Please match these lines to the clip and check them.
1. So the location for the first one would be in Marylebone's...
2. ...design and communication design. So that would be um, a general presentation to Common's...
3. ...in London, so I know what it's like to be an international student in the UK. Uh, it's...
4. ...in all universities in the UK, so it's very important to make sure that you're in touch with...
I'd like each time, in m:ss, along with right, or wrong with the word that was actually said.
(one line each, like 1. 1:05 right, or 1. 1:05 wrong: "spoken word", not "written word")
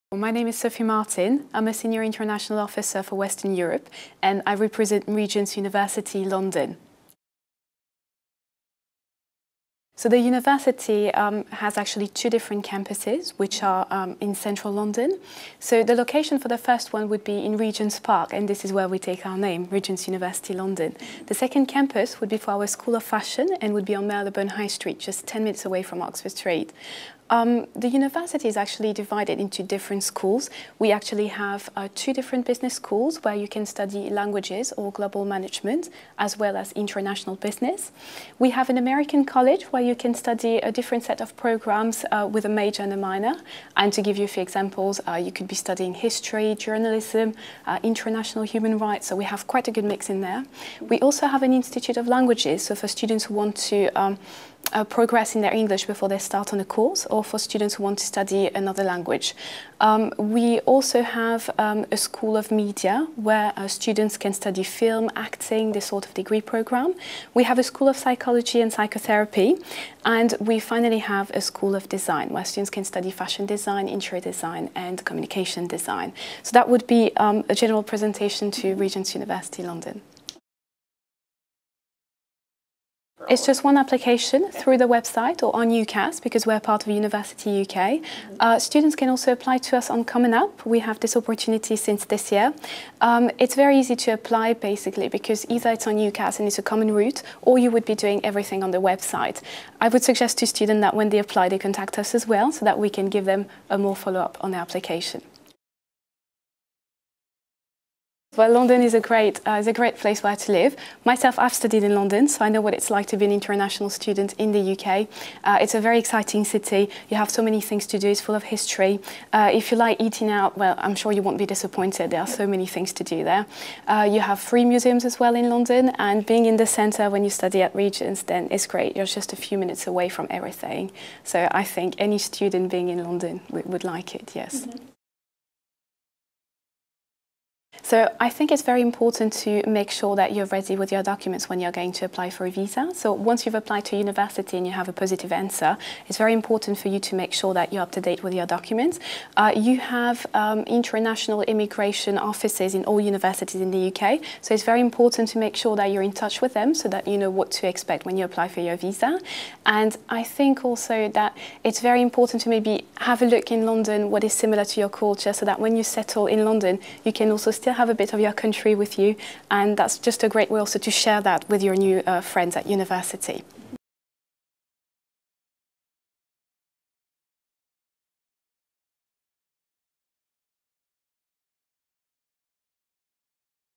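1. 0:15 wrong: "Regent", not "Marylebone"
2. 1:14 wrong: "Regent", not "Common"
3. 1:51 right
4. 2:32 right.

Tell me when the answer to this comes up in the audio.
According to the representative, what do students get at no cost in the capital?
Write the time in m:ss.
2:04.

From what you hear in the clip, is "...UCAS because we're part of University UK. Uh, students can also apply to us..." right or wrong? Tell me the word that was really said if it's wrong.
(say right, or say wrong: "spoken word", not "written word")
right.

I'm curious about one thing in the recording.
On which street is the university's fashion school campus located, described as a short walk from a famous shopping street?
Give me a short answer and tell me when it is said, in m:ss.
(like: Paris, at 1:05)
Marylebone High Street, at 0:24.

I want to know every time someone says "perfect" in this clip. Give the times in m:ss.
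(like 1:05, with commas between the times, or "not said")
not said.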